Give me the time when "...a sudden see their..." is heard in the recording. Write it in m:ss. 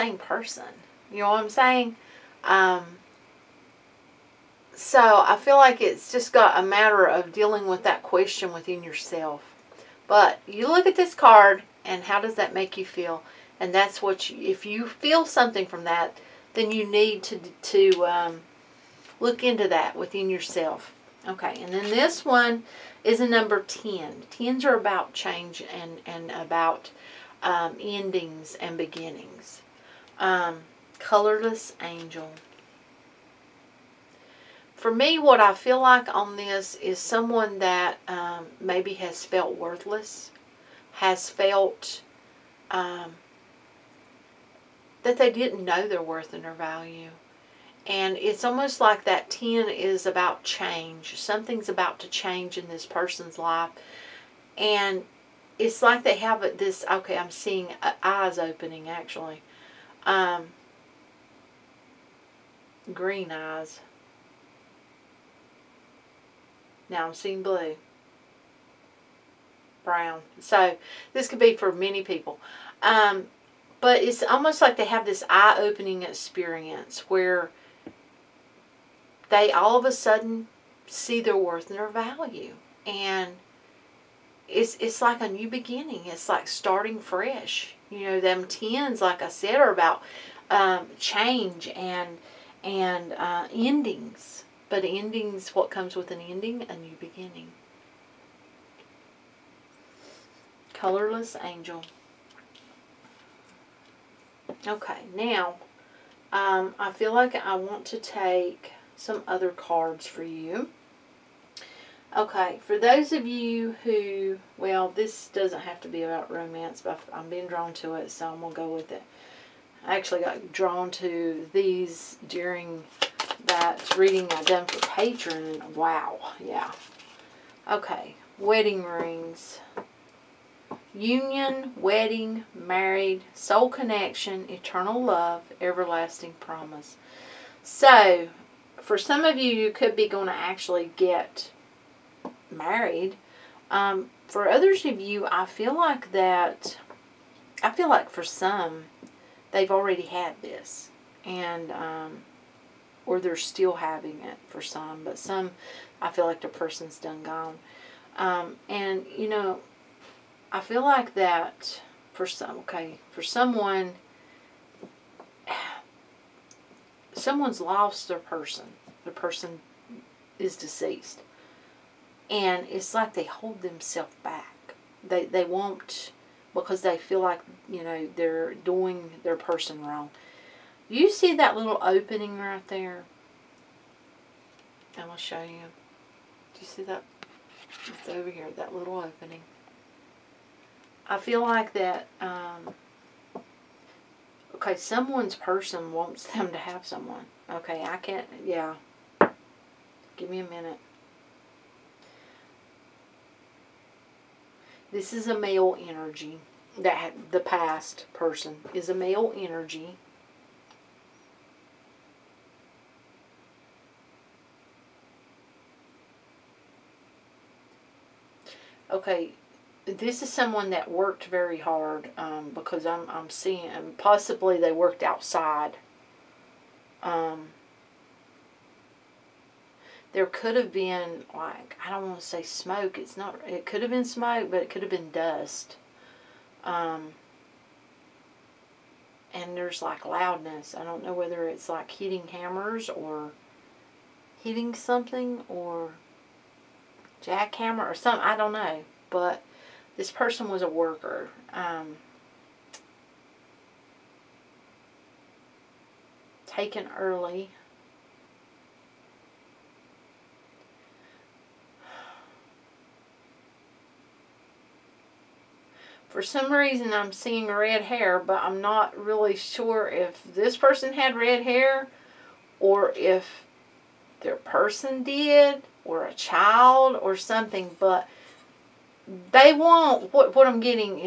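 1:19.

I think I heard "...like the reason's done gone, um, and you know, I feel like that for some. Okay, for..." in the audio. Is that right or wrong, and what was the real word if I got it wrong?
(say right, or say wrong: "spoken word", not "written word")
wrong: "person", not "reason".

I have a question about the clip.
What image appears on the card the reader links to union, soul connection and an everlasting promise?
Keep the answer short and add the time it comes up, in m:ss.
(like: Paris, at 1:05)
Wedding rings, at 2:08.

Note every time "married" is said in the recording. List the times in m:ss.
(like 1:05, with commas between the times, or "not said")
2:12, 2:22.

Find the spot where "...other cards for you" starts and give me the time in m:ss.
1:49.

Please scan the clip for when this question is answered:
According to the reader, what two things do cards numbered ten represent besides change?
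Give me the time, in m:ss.
0:27.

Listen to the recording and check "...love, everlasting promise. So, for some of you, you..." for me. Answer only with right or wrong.
right.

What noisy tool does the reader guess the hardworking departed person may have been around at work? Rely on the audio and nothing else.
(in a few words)
Jackhammer.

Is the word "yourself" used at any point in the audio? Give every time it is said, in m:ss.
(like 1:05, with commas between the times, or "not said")
0:08, 0:20.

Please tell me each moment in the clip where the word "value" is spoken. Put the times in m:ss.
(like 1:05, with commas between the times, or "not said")
0:46, 1:21.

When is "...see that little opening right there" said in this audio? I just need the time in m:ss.
3:01.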